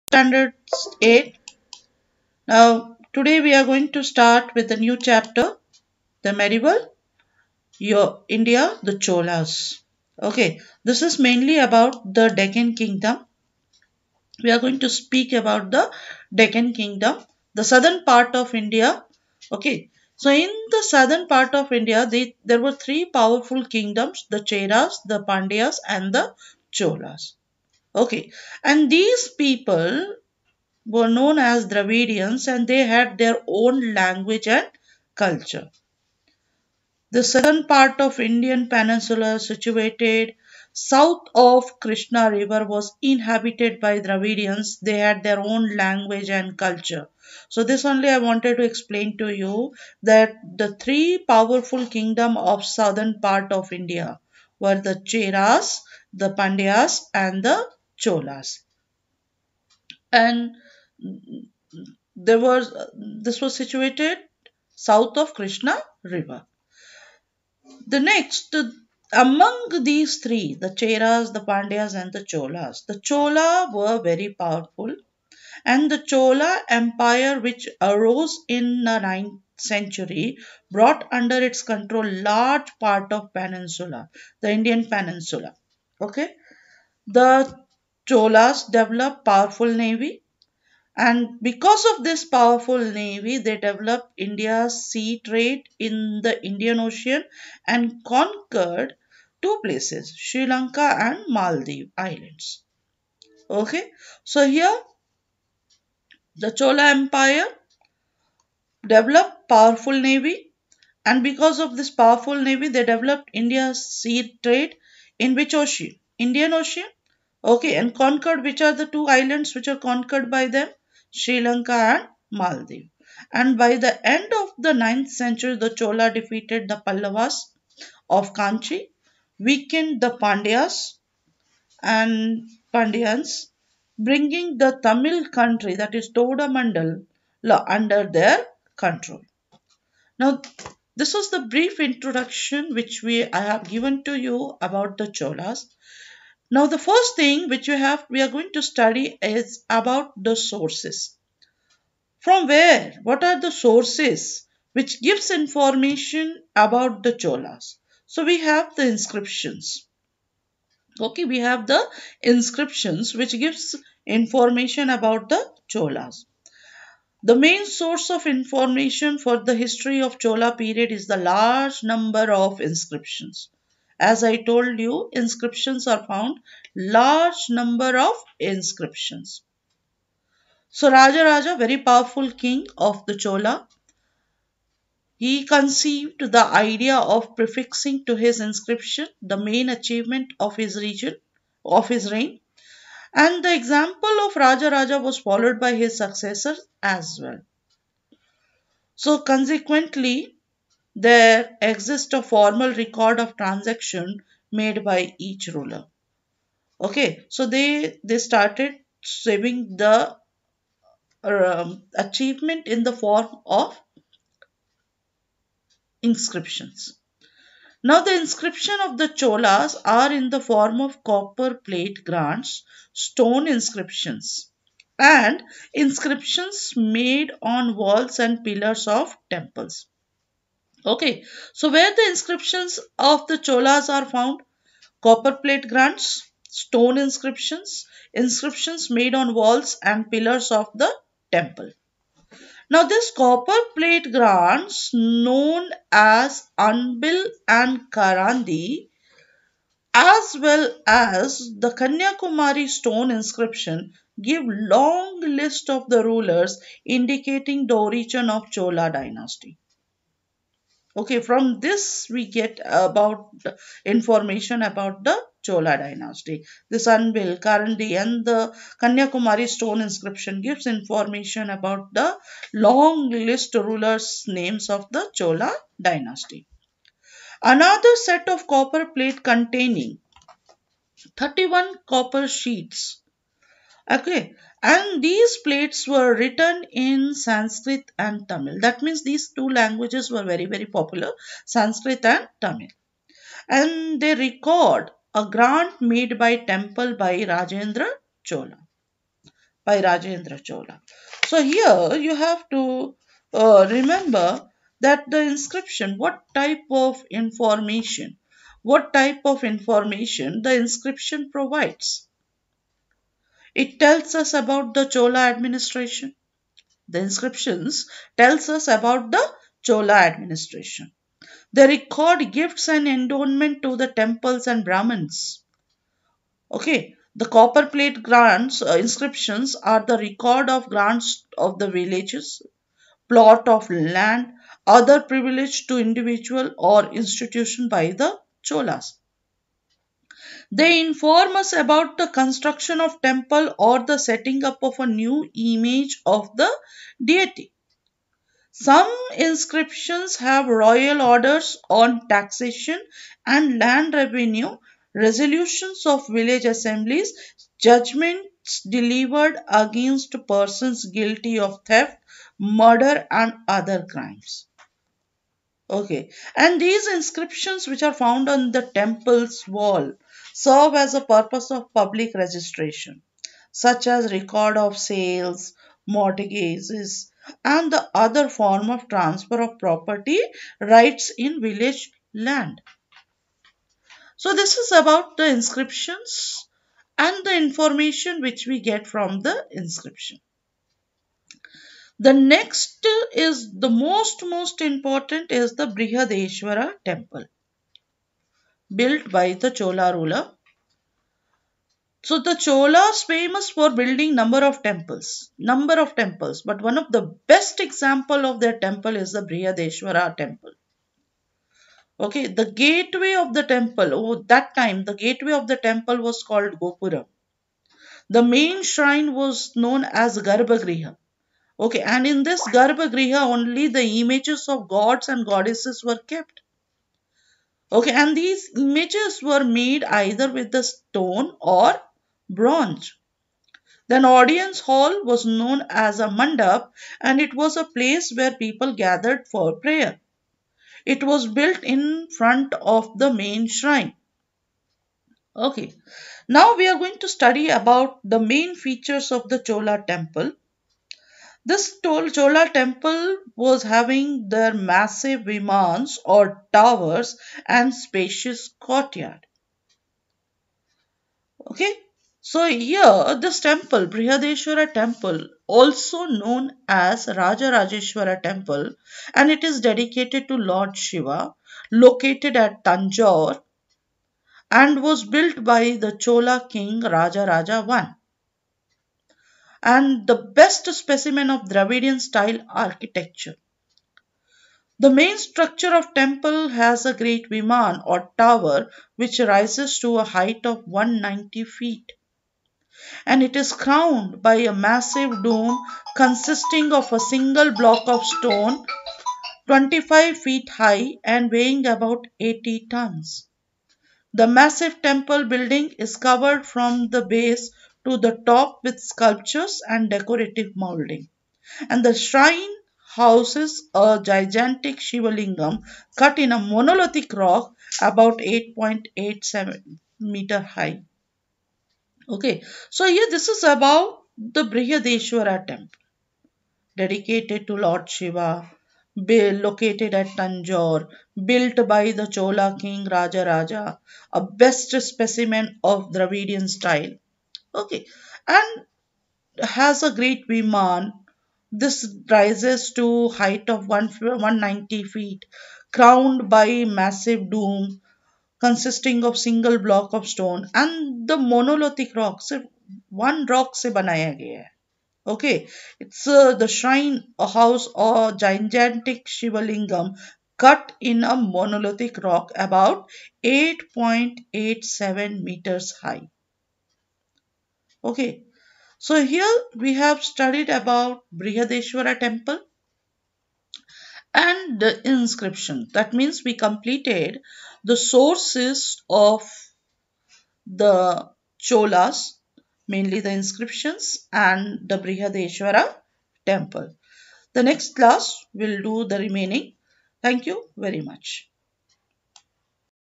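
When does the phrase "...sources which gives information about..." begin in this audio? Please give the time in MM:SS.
02:33.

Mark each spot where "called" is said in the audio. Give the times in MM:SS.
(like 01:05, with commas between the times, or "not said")
06:56.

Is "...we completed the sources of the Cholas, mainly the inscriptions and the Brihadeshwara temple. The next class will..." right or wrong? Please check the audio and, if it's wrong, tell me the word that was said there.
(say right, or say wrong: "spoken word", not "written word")
right.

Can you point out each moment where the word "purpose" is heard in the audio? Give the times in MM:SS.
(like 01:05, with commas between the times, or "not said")
06:11.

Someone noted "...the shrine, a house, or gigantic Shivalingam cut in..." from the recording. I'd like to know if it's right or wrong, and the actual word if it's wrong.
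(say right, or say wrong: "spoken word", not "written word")
right.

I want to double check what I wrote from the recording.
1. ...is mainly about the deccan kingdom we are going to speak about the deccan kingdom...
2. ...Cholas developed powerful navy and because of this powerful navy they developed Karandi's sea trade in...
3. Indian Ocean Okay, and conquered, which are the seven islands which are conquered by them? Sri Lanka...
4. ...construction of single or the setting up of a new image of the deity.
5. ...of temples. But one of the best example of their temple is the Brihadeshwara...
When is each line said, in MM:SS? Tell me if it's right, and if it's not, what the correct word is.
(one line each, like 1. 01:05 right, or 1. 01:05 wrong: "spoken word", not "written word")
1. 00:11 right
2. 01:28 wrong: "India", not "Karandi"
3. 01:56 wrong: "two", not "seven"
4. 05:42 wrong: "temple", not "single"
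5. 06:45 right.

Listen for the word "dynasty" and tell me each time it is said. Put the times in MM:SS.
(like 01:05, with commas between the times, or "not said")
04:18, 04:25, 04:35.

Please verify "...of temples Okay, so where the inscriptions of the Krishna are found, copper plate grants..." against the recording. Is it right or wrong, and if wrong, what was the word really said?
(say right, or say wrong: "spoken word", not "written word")
wrong: "Cholas", not "Krishna".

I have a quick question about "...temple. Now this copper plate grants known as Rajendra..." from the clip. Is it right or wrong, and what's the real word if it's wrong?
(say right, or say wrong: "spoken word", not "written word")
wrong: "Anbil", not "Rajendra".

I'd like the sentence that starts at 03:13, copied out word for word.
And the example of Raja Raja was followed by his successors as well.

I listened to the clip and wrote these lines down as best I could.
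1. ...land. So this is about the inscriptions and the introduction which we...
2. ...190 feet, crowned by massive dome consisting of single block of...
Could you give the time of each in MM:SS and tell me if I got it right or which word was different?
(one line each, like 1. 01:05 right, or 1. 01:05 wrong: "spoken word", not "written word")
1. 06:22 wrong: "information", not "introduction"
2. 09:03 right.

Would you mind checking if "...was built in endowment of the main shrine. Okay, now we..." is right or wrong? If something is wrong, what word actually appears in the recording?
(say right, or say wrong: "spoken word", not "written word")
wrong: "front", not "endowment".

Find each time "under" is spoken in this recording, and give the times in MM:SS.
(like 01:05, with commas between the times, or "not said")
01:21, 02:17.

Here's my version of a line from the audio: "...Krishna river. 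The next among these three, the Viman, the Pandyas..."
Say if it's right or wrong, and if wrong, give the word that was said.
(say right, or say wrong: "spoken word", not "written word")
wrong: "Cheras", not "Viman".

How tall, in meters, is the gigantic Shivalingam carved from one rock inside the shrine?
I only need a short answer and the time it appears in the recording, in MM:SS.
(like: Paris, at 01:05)
8.87 meters, at 08:38.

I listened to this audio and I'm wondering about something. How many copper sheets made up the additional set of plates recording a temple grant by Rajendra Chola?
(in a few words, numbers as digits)
31.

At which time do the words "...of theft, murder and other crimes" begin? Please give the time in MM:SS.
06:01.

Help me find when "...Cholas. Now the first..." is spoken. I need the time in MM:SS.
02:25.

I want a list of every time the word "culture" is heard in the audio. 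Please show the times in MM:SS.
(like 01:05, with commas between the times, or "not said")
00:35, 00:46.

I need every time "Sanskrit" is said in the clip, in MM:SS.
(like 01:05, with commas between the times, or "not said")
04:47, 04:51.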